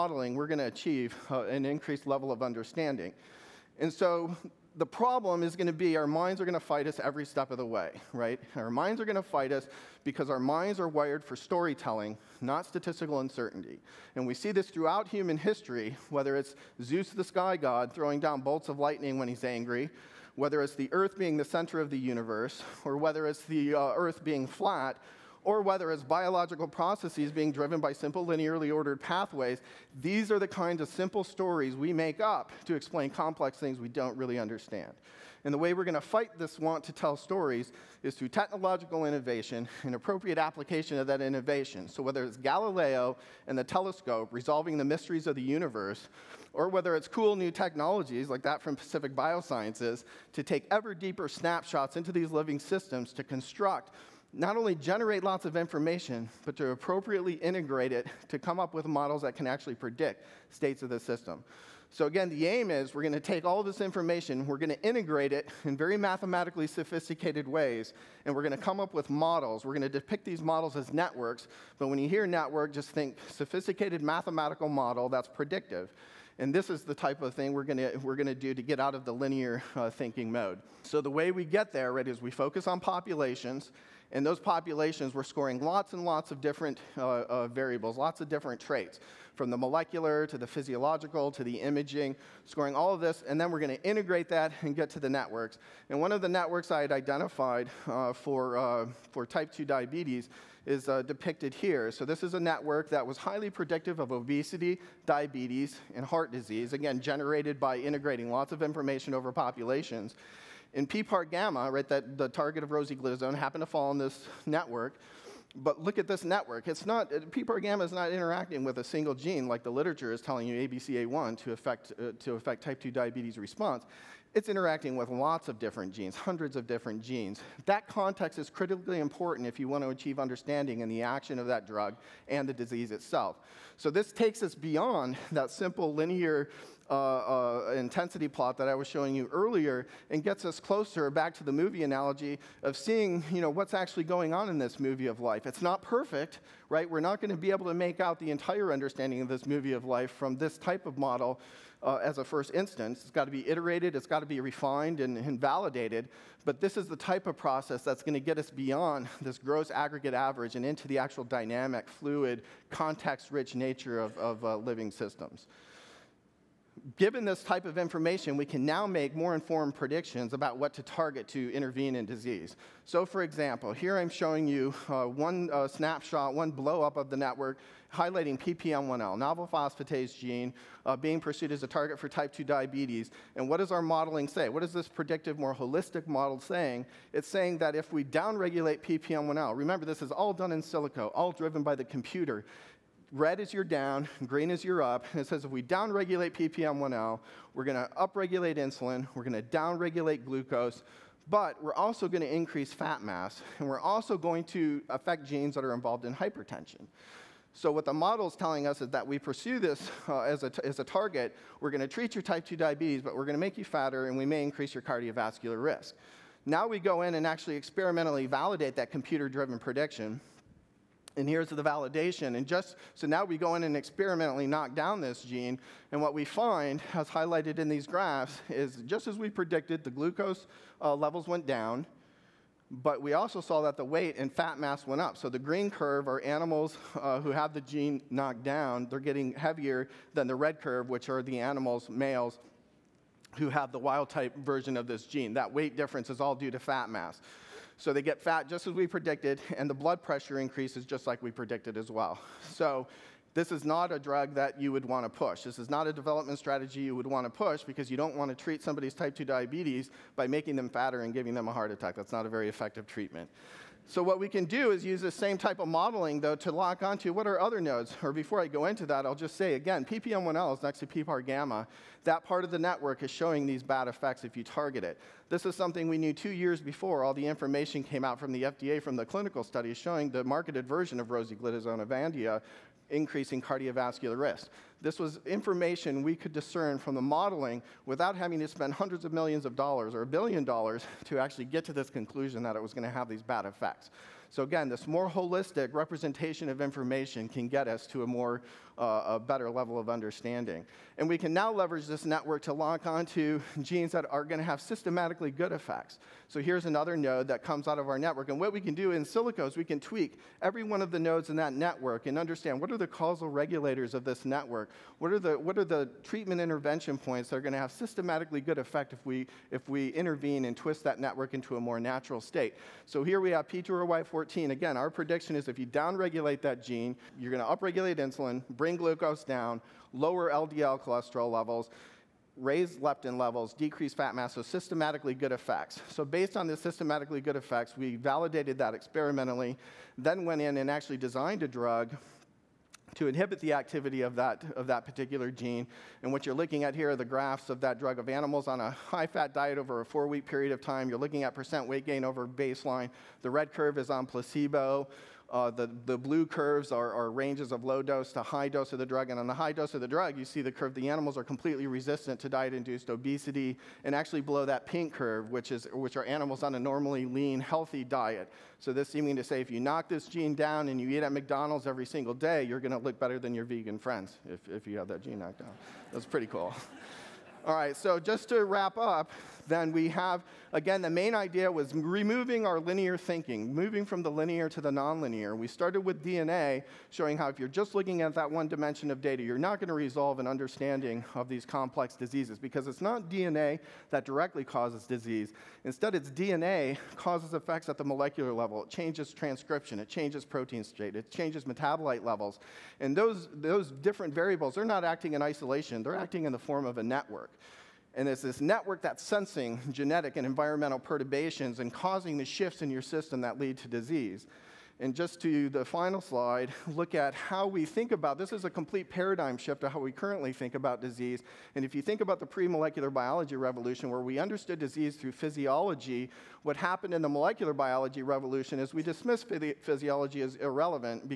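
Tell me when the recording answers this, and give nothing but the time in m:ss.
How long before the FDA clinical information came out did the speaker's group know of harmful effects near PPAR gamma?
4:36.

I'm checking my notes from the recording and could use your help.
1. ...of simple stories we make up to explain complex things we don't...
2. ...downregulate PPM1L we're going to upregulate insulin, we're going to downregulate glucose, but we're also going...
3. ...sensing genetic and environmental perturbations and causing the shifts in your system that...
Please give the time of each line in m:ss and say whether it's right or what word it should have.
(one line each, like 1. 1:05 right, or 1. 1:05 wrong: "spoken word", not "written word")
1. 0:30 right
2. 3:15 right
3. 6:49 right.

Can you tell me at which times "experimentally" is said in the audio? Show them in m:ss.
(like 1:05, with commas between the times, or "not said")
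3:37, 3:43, 5:38.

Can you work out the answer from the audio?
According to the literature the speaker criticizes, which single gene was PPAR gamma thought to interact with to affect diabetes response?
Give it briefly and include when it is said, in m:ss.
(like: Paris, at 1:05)
ABCA1, at 2:00.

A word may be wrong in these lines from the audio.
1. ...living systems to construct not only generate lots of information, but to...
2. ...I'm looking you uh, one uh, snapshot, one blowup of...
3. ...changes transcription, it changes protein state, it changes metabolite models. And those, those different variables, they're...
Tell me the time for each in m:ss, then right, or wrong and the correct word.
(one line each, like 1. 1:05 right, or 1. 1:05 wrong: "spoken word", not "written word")
1. 0:52 right
2. 2:53 wrong: "showing", not "looking"
3. 6:38 wrong: "levels", not "models".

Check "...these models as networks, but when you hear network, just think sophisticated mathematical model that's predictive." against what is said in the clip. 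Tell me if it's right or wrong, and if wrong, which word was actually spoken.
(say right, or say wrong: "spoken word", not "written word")
right.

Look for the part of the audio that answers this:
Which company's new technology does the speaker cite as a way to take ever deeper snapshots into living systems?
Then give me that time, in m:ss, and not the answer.
0:48.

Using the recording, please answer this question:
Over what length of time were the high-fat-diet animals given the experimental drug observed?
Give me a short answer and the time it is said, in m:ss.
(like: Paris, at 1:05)
4 weeks, at 5:49.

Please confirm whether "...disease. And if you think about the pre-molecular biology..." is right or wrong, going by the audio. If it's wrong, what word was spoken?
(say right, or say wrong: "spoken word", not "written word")
right.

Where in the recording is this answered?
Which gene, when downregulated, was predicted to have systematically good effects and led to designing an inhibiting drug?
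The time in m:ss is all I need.
5:23.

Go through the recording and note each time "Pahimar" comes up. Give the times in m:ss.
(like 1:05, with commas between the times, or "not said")
not said.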